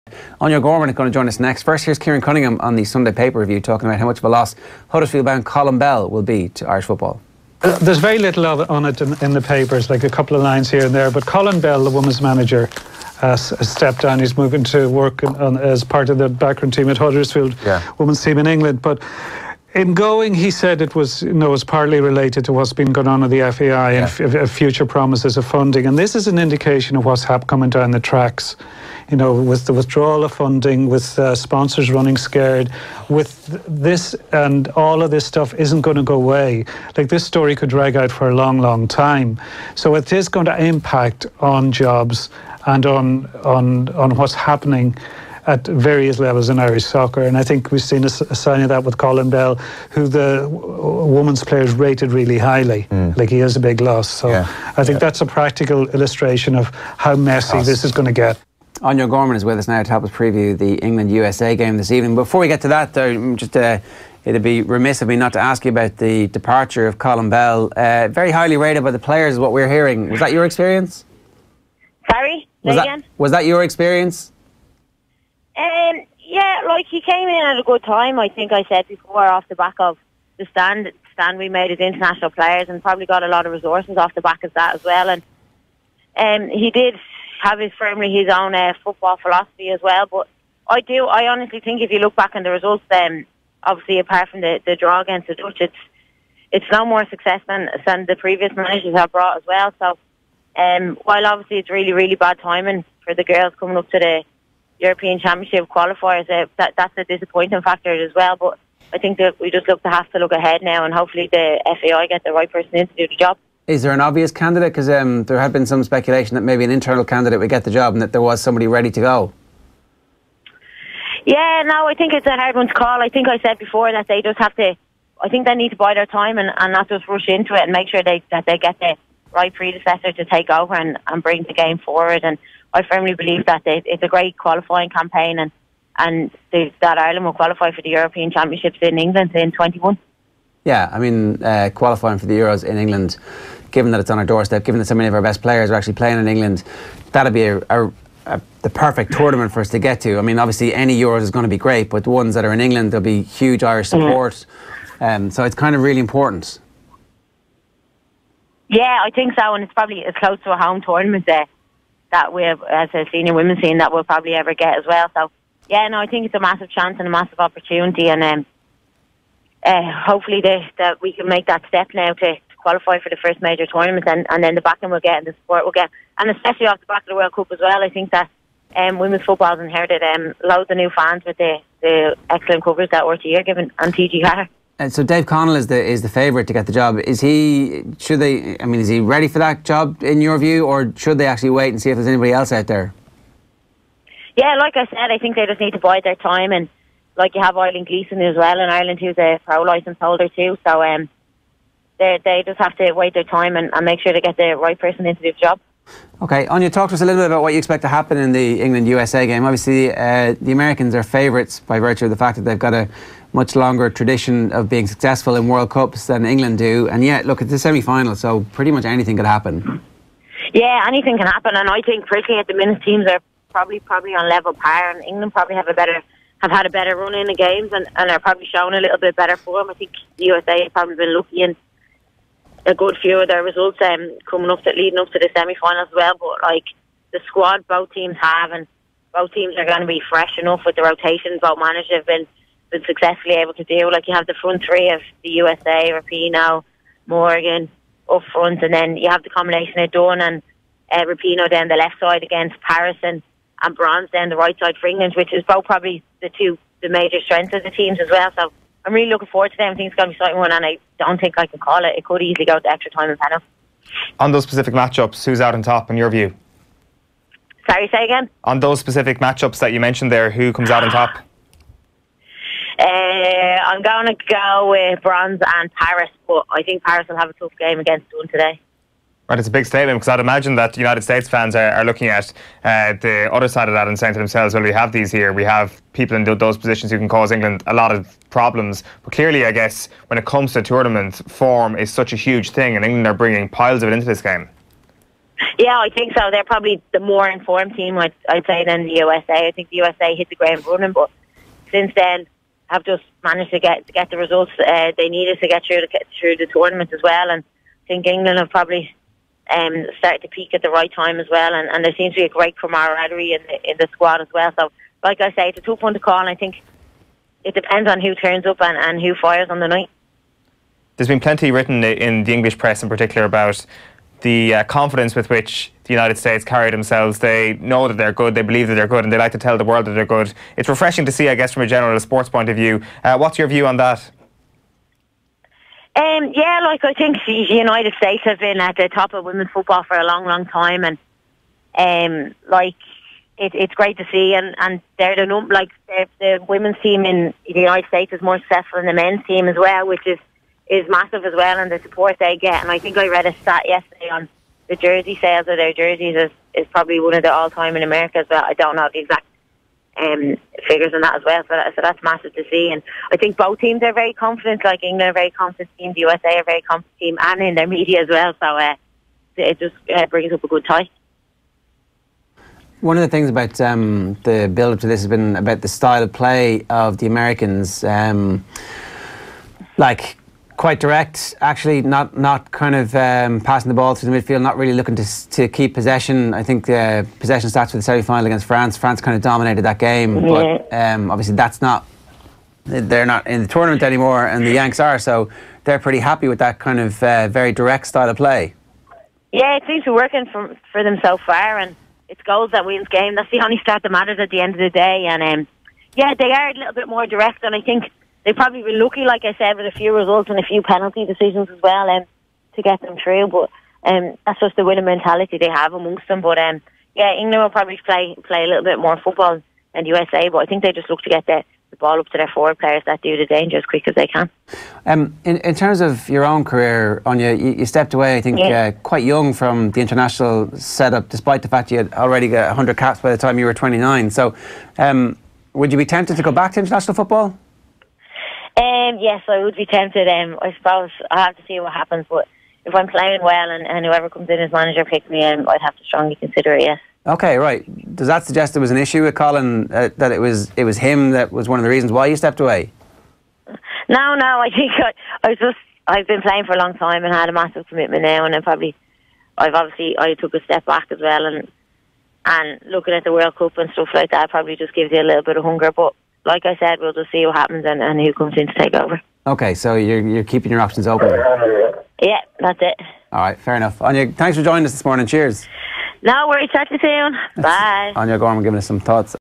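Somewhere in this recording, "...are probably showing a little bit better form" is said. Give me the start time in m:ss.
3:48.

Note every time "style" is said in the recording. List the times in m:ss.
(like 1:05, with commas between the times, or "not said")
6:15, 6:37.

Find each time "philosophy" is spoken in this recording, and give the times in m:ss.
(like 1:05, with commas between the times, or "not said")
1:29.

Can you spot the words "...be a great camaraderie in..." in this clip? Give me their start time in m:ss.
5:12.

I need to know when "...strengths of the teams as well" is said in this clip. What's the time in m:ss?
4:17.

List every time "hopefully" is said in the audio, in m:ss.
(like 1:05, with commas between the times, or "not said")
1:50, 2:50.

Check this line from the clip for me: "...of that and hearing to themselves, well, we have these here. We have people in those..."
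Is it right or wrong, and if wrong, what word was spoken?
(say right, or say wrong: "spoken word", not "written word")
wrong: "saying", not "hearing".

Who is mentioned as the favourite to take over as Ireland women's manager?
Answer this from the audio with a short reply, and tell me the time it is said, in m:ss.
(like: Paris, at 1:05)
Dave Connell, at 3:05.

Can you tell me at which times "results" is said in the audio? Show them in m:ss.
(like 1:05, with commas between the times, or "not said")
1:32, 3:53, 5:04, 6:49.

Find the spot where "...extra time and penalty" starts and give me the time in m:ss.
4:22.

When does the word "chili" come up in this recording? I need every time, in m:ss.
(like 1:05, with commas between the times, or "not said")
not said.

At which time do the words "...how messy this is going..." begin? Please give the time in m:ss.
0:56.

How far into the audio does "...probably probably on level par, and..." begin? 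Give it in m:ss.
3:43.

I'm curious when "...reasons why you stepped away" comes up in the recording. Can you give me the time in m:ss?
7:31.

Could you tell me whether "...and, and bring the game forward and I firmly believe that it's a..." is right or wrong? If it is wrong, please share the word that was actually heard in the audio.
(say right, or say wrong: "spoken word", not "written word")
right.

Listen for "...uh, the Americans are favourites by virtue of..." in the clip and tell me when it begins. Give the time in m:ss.
3:29.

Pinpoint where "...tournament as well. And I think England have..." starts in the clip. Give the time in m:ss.
5:06.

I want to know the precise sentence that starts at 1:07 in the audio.
Uh, very highly rated by the players, is what we're hearing.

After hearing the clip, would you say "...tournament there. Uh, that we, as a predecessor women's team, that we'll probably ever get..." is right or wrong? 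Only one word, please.
wrong.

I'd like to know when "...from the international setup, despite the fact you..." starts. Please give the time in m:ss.
7:09.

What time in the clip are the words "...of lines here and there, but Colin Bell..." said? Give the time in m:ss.
0:10.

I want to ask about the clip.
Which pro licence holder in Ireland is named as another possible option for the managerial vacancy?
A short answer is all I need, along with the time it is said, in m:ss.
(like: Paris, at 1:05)
Eileen Gleeson, at 3:17.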